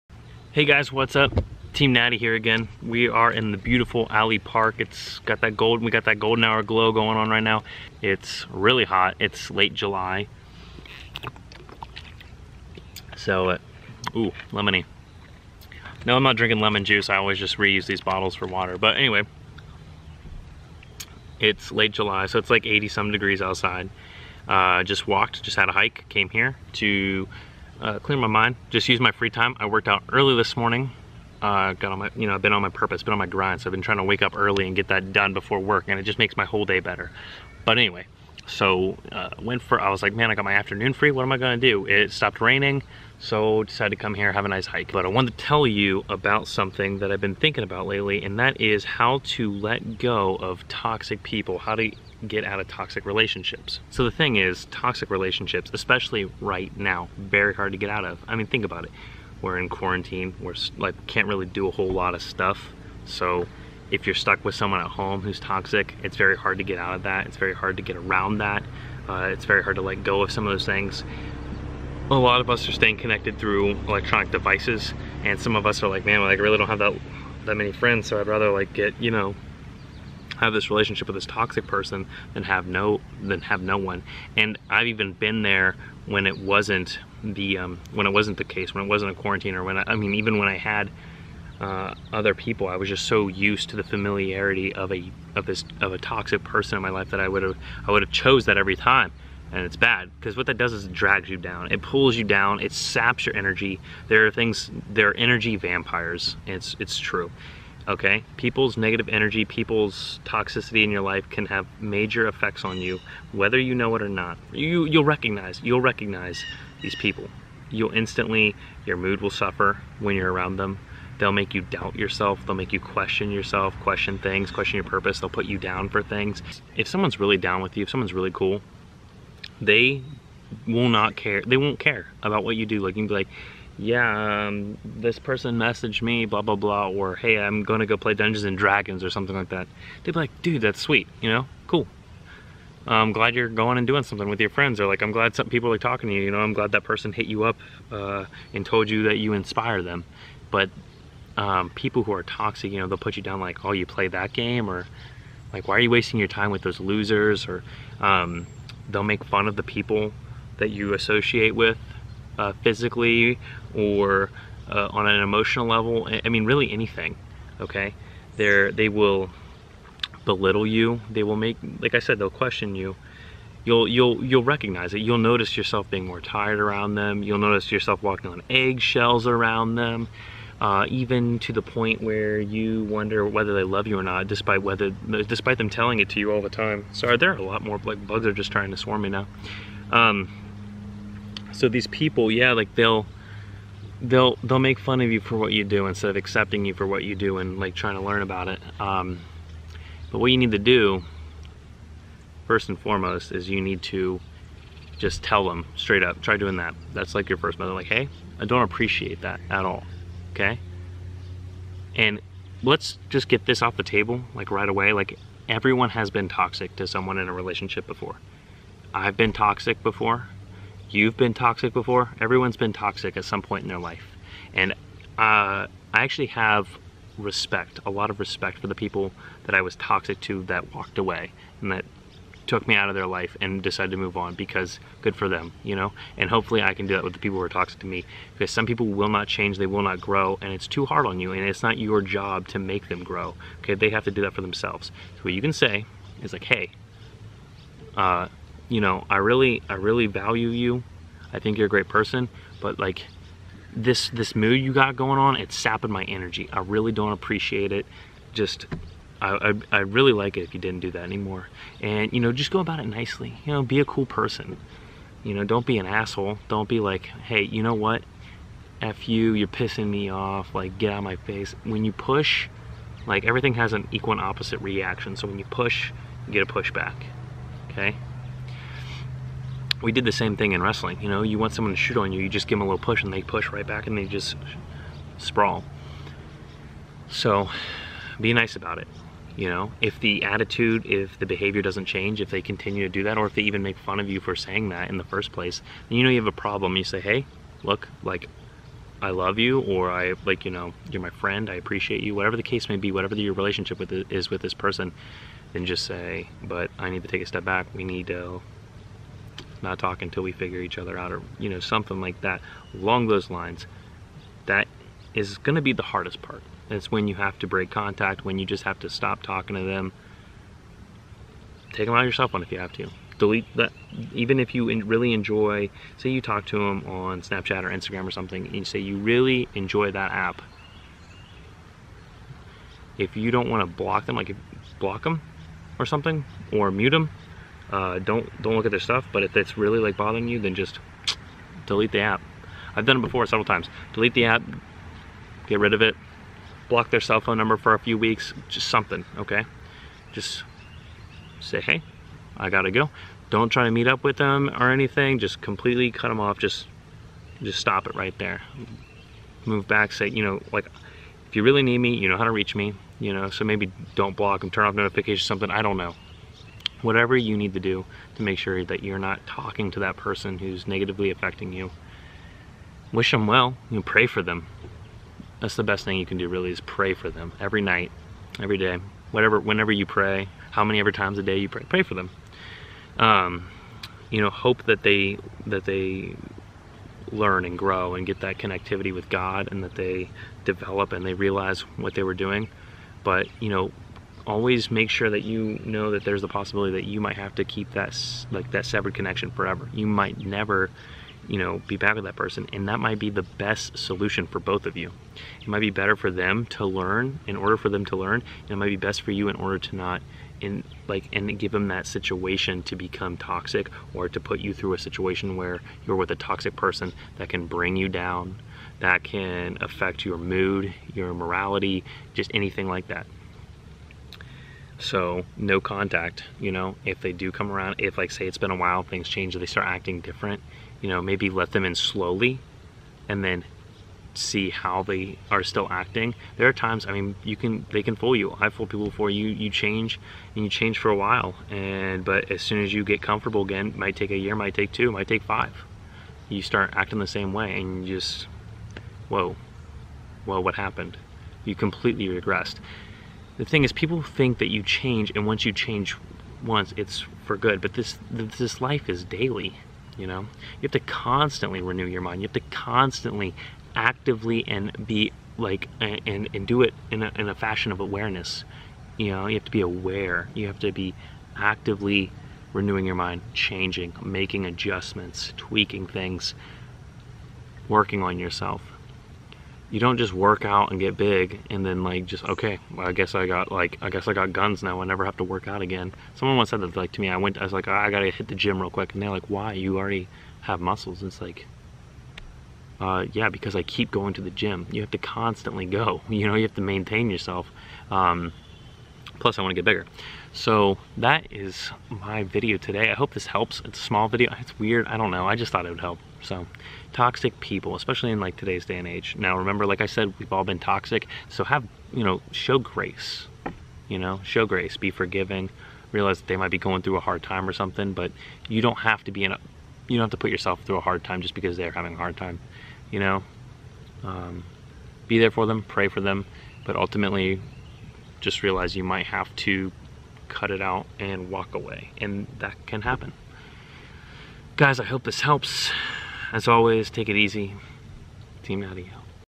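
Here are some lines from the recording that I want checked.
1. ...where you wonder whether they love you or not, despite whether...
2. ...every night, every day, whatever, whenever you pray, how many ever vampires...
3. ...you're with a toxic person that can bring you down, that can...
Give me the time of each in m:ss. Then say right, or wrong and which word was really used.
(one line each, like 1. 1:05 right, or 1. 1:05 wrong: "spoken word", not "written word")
1. 3:02 right
2. 6:17 wrong: "times", not "vampires"
3. 6:55 right.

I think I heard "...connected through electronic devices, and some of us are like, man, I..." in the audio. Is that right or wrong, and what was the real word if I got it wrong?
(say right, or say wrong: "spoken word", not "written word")
right.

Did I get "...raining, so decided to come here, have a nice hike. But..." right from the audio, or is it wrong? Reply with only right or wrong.
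right.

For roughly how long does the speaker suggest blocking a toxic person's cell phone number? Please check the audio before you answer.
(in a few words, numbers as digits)
a few weeks.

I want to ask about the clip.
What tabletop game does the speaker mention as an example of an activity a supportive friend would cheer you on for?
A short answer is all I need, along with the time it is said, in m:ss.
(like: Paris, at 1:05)
Dungeons and Dragons, at 2:18.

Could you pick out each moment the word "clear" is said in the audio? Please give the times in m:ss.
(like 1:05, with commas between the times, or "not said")
0:27.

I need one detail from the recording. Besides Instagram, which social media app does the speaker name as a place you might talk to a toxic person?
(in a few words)
Snapchat.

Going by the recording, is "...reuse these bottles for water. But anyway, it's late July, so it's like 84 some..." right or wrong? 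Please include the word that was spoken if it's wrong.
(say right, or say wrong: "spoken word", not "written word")
wrong: "80", not "84".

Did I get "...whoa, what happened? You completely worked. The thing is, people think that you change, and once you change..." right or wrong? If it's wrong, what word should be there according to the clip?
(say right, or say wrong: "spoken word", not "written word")
wrong: "regressed", not "worked".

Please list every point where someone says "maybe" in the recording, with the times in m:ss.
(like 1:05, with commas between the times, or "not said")
6:03, 7:11.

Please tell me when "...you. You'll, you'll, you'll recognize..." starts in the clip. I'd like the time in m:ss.
2:52.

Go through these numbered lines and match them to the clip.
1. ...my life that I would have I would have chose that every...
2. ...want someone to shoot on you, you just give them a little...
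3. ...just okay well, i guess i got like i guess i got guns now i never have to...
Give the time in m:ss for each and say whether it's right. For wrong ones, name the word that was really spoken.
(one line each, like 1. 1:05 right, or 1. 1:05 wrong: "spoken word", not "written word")
1. 1:36 right
2. 4:41 right
3. 8:02 right.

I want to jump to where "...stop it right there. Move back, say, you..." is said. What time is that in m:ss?
5:57.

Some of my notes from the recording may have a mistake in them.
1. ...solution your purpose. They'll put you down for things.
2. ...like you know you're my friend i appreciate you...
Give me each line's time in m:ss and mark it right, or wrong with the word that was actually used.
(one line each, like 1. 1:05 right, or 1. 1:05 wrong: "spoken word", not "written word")
1. 2:04 wrong: "question", not "solution"
2. 5:00 right.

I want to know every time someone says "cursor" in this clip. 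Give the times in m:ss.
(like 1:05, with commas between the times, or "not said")
not said.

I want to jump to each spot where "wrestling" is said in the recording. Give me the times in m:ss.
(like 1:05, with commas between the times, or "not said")
4:40.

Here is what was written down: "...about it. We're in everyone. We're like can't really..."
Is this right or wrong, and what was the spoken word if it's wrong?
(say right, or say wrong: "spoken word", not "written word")
wrong: "quarantine", not "everyone".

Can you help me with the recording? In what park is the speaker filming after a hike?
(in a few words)
Alley Park.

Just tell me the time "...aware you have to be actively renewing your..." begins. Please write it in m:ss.
7:49.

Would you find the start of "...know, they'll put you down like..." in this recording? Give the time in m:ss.
2:32.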